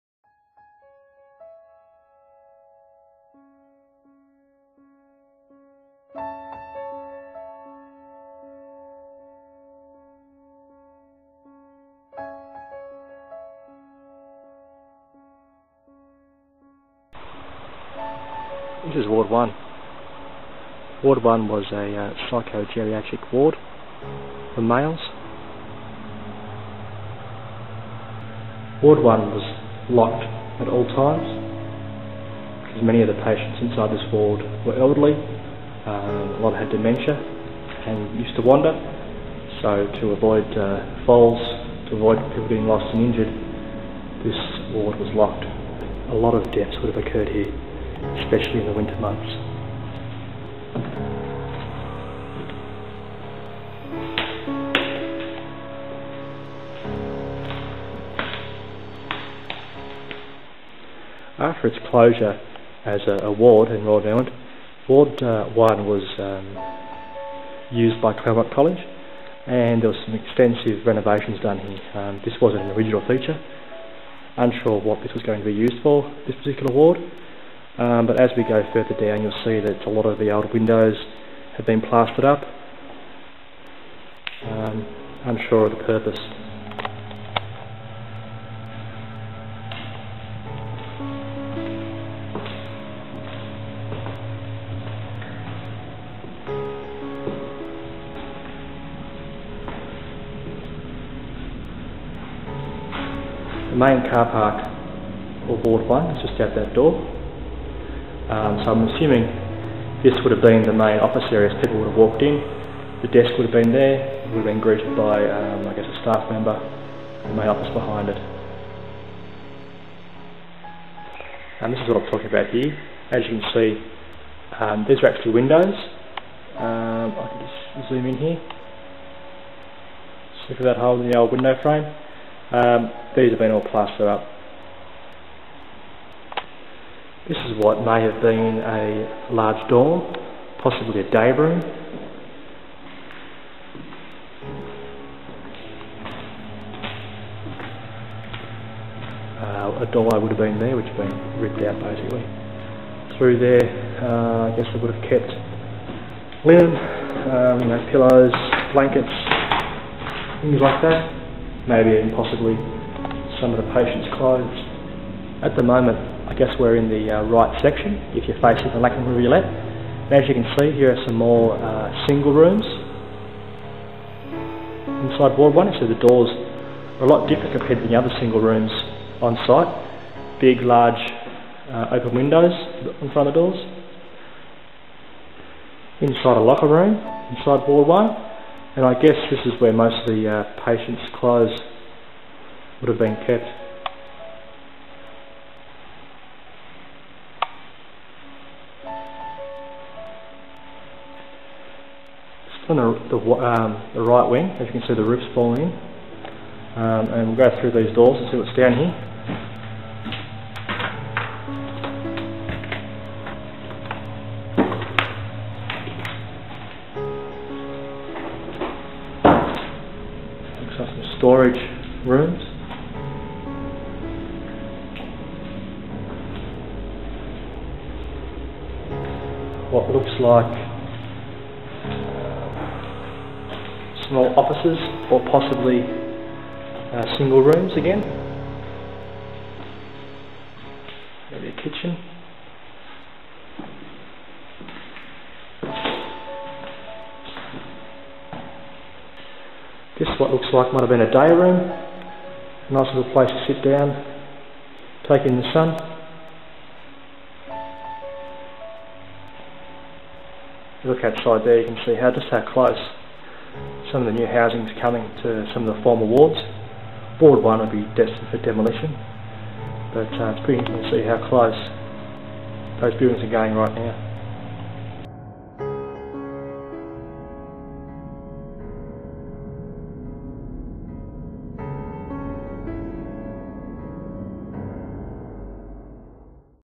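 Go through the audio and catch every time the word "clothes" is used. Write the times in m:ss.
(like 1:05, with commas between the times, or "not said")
2:44, 3:11.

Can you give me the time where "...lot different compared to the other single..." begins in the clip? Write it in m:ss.
2:57.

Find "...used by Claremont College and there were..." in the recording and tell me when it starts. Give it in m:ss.
1:07.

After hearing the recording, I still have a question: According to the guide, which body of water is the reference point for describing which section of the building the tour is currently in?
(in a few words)
Lachlan Rivulet.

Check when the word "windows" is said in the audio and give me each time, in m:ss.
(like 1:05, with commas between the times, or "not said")
1:20, 2:05, 2:11, 3:02.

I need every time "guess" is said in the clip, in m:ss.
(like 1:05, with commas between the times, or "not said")
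1:55, 2:34, 2:46, 3:08.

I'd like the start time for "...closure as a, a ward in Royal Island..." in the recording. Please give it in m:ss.
1:01.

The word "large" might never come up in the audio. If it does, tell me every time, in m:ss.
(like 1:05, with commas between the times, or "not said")
2:19, 3:00.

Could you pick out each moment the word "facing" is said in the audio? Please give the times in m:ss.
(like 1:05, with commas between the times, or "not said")
2:48.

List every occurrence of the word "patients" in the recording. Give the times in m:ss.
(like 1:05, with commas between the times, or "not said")
0:33, 2:43, 3:10.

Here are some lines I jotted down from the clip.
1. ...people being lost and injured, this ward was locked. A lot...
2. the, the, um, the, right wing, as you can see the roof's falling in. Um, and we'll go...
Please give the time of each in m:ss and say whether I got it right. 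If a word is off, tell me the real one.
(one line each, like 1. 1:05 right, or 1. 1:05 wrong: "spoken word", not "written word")
1. 0:42 right
2. 3:22 right.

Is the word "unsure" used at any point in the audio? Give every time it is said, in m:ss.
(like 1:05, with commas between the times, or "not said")
1:14, 1:25.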